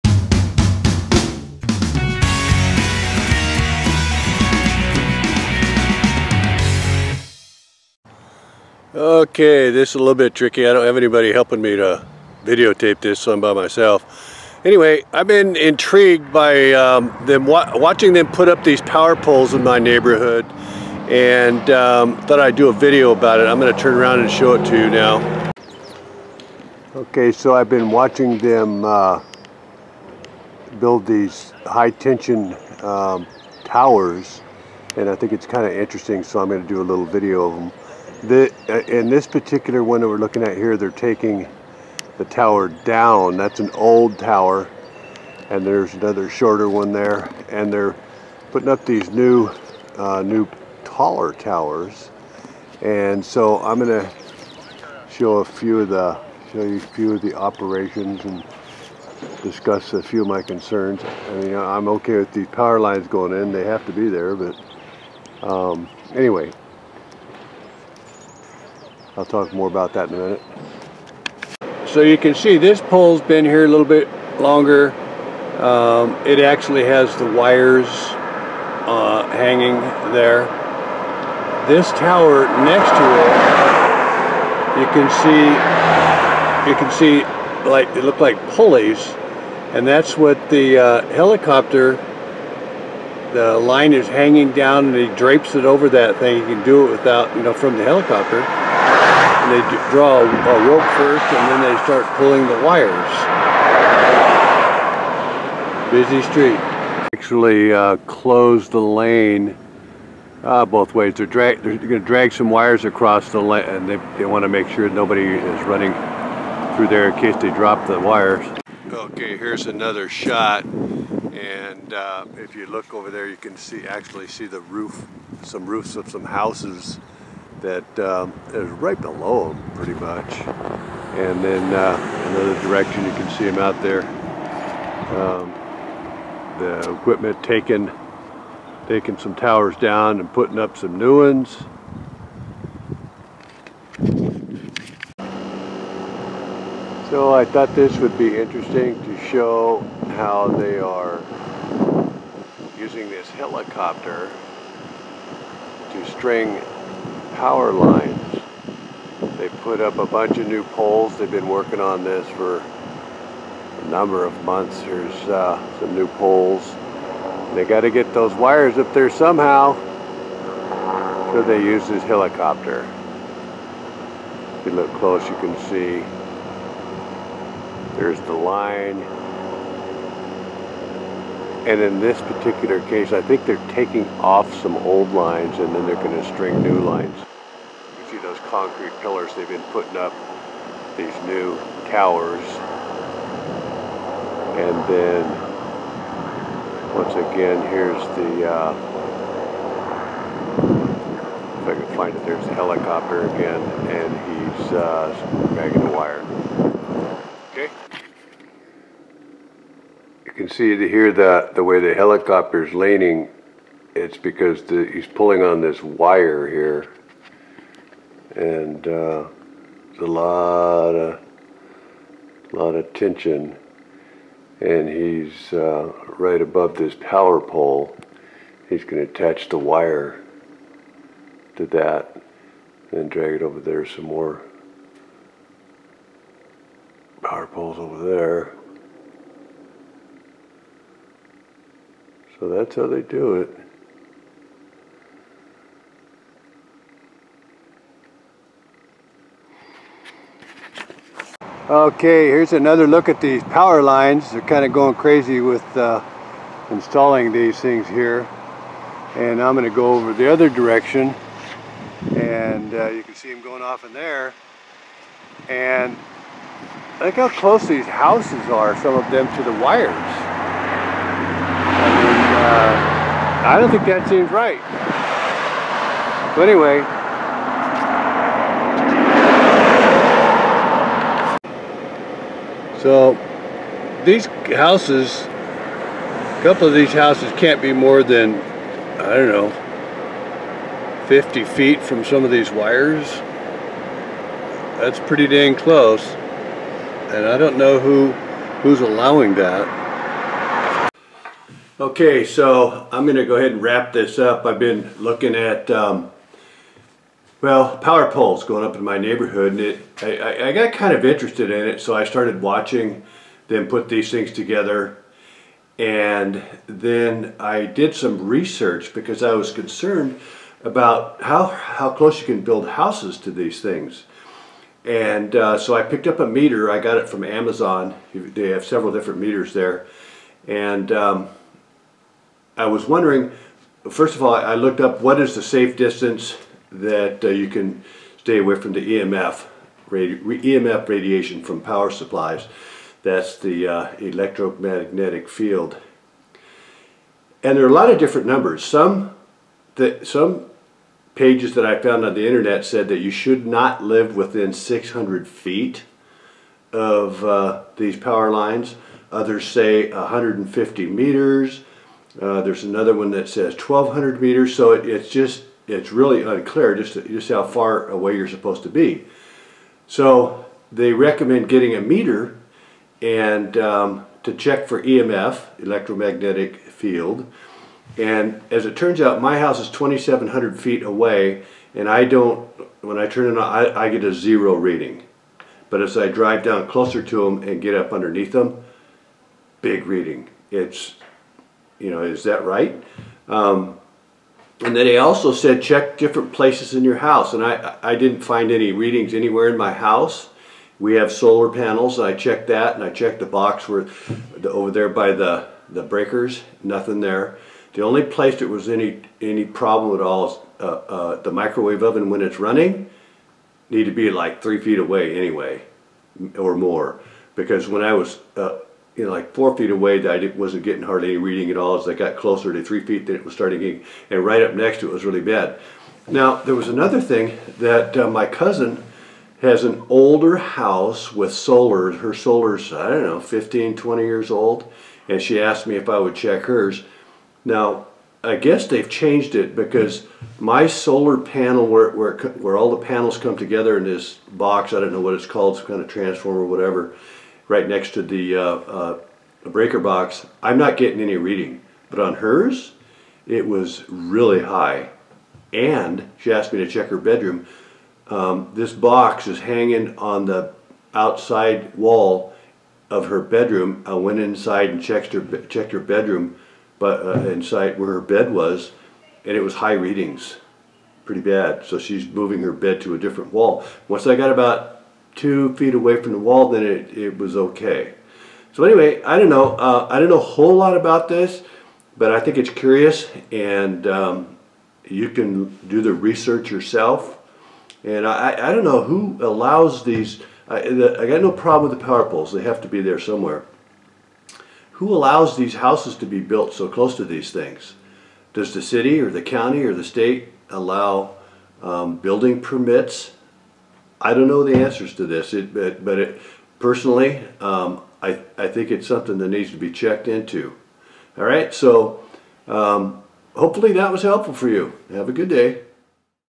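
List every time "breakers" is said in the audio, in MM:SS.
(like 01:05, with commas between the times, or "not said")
06:45, 07:29.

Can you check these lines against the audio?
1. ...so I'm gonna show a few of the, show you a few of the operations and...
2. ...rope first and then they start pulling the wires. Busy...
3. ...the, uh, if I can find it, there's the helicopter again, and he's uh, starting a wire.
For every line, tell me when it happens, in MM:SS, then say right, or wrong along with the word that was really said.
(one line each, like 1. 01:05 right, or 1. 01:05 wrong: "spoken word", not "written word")
1. 00:53 right
2. 01:40 right
3. 03:18 wrong: "dragging", not "starting".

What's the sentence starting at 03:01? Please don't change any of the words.
And in this particular case, I think they're taking off some old lines and then they're going to string new lines.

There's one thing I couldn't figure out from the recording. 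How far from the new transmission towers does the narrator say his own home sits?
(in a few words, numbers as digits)
2,700 feet.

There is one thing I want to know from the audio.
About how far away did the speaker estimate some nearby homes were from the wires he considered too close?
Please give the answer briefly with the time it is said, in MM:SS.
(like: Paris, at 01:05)
50 feet, at 04:51.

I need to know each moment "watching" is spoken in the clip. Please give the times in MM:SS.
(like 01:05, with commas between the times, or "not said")
00:17, 00:27, 05:12.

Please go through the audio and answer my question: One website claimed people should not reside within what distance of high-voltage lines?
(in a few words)
600 feet.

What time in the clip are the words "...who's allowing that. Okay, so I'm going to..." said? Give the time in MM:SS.
04:58.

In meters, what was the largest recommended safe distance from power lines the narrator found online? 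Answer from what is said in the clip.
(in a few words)
1200 meters.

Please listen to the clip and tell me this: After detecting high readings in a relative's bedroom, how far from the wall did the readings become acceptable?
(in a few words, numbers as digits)
2 feet.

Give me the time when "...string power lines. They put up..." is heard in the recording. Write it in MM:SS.
02:36.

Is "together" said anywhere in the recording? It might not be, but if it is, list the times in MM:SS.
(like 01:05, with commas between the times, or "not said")
05:14, 07:23.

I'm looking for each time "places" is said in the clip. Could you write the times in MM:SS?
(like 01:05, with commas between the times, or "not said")
06:36, 06:48.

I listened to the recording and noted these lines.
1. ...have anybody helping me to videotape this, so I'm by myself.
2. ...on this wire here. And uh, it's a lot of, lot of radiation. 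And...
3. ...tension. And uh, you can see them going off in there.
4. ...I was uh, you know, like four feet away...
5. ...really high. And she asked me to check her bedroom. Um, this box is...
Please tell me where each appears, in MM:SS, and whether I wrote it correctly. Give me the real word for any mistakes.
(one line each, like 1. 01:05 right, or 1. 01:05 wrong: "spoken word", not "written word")
1. 00:10 right
2. 03:35 wrong: "tension", not "radiation"
3. 04:20 wrong: "direction", not "tension"
4. 06:57 right
5. 07:33 right.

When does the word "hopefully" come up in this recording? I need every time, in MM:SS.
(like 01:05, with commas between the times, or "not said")
08:33.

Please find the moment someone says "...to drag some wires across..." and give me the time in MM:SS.
01:51.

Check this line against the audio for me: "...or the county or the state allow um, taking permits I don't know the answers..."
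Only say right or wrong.
wrong.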